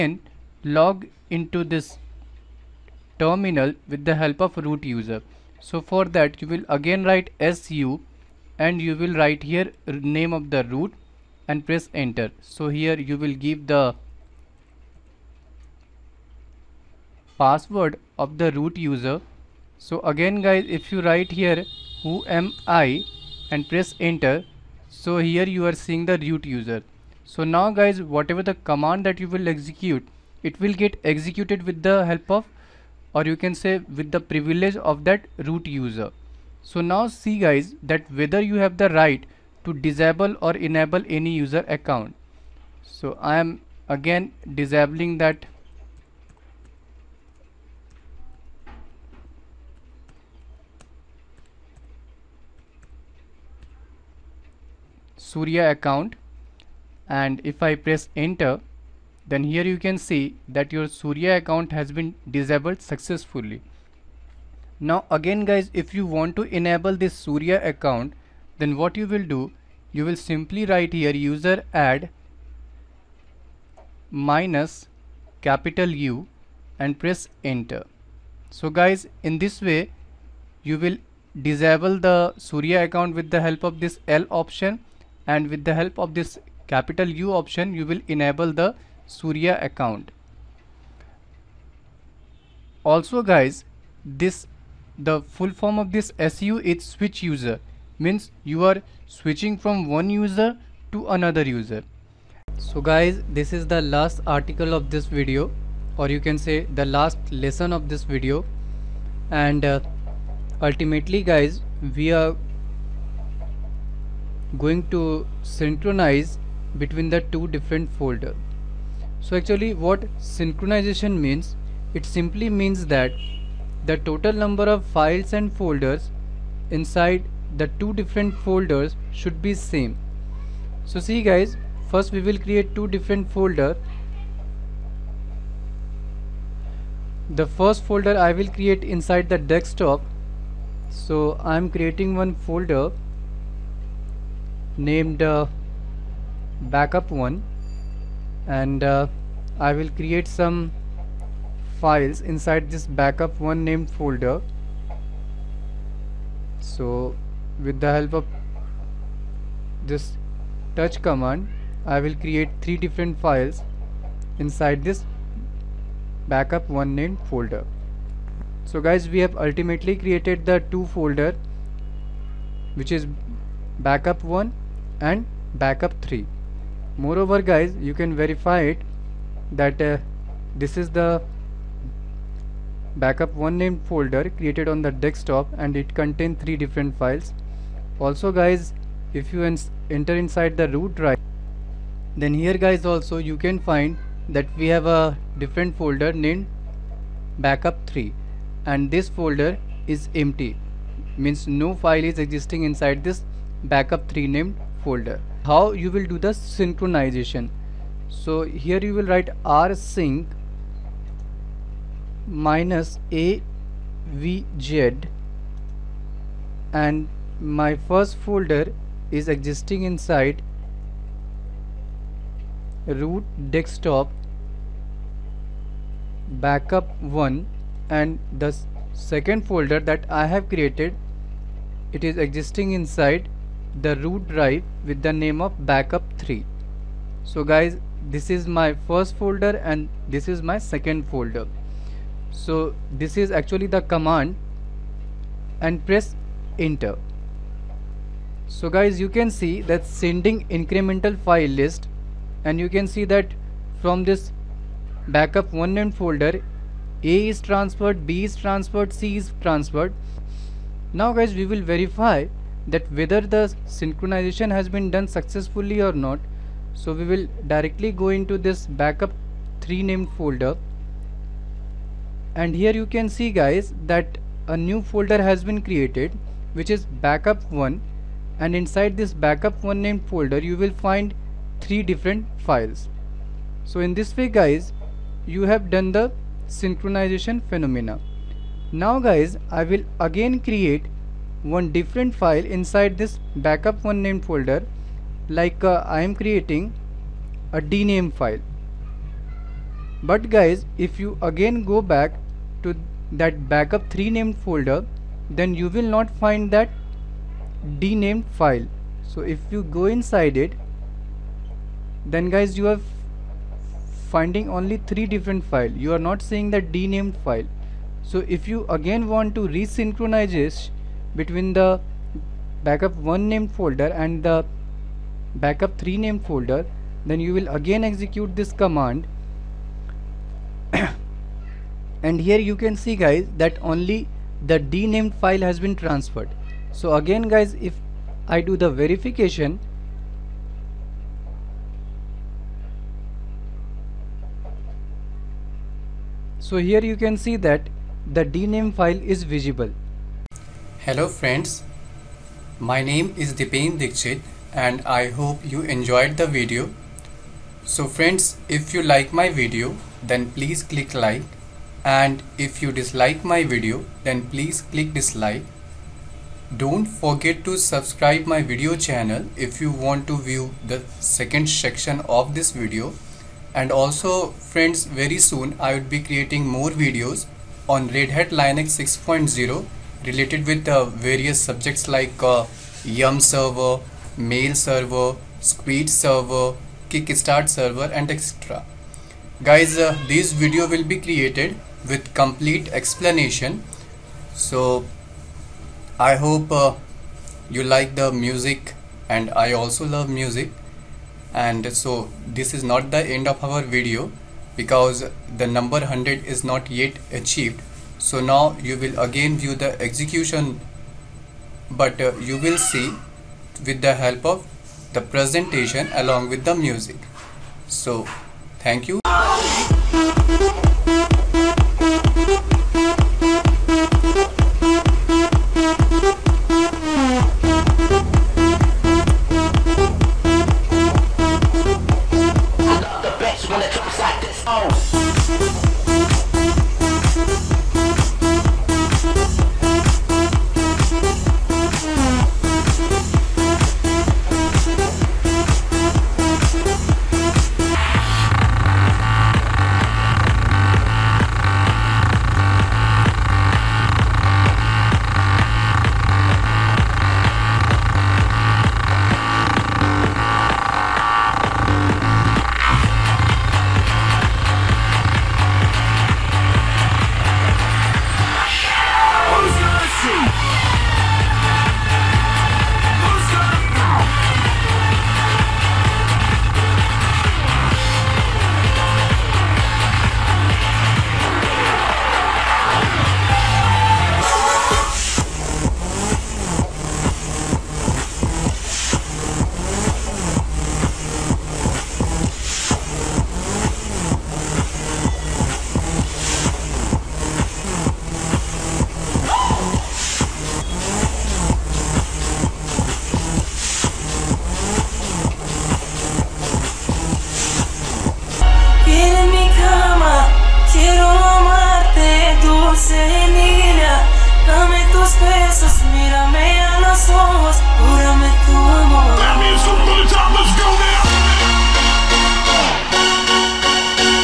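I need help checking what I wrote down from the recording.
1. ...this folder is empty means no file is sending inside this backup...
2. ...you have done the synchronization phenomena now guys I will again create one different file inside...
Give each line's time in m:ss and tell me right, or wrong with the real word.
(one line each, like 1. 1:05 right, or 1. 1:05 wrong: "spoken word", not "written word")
1. 3:18 wrong: "existing", not "sending"
2. 4:45 right.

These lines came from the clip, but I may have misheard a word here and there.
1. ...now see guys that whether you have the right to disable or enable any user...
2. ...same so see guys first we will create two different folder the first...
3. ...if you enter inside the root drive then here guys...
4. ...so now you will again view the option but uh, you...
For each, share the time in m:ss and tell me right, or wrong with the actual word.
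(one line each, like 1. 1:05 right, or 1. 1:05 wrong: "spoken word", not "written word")
1. 0:36 right
2. 2:09 right
3. 3:09 right
4. 6:47 wrong: "execution", not "option".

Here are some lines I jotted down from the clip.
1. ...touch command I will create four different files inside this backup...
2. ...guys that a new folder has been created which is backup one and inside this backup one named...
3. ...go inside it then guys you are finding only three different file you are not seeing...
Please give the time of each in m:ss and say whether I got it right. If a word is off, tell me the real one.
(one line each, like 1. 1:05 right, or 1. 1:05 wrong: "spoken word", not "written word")
1. 2:40 wrong: "three", not "four"
2. 4:33 right
3. 5:09 right.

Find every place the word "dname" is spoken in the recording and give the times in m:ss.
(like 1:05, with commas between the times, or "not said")
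4:57, 5:48.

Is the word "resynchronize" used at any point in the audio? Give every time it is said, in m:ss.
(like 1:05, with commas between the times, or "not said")
5:19.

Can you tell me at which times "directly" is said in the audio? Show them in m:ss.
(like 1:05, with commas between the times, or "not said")
4:27.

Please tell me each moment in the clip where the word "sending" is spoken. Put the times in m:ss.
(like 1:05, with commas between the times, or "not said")
4:09.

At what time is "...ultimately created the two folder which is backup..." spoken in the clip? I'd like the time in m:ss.
2:49.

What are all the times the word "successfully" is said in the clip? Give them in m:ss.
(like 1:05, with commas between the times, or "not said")
1:02, 4:25.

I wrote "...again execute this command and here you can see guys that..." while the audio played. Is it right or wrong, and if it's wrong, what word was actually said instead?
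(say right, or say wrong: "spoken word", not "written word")
right.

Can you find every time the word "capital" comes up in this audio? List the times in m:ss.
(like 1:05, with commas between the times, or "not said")
1:15, 1:26.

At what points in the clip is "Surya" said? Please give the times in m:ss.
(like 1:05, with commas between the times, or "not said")
0:55, 1:00, 1:07, 1:22, 1:29.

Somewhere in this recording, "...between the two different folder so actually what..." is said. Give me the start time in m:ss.
1:56.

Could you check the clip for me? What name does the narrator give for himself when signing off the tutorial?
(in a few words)
Dipen Dixit.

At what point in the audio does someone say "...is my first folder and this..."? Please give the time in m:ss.
3:58.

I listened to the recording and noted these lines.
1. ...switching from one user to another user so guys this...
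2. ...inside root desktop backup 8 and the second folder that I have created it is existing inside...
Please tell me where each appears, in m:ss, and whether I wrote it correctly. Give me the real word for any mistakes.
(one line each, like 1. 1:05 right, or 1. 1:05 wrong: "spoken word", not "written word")
1. 1:39 right
2. 3:39 wrong: "1", not "8".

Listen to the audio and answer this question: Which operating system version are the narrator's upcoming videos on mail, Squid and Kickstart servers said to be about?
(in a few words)
Red Hat Linux 6.0.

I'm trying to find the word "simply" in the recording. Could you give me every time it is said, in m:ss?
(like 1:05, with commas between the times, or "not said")
1:10, 2:02.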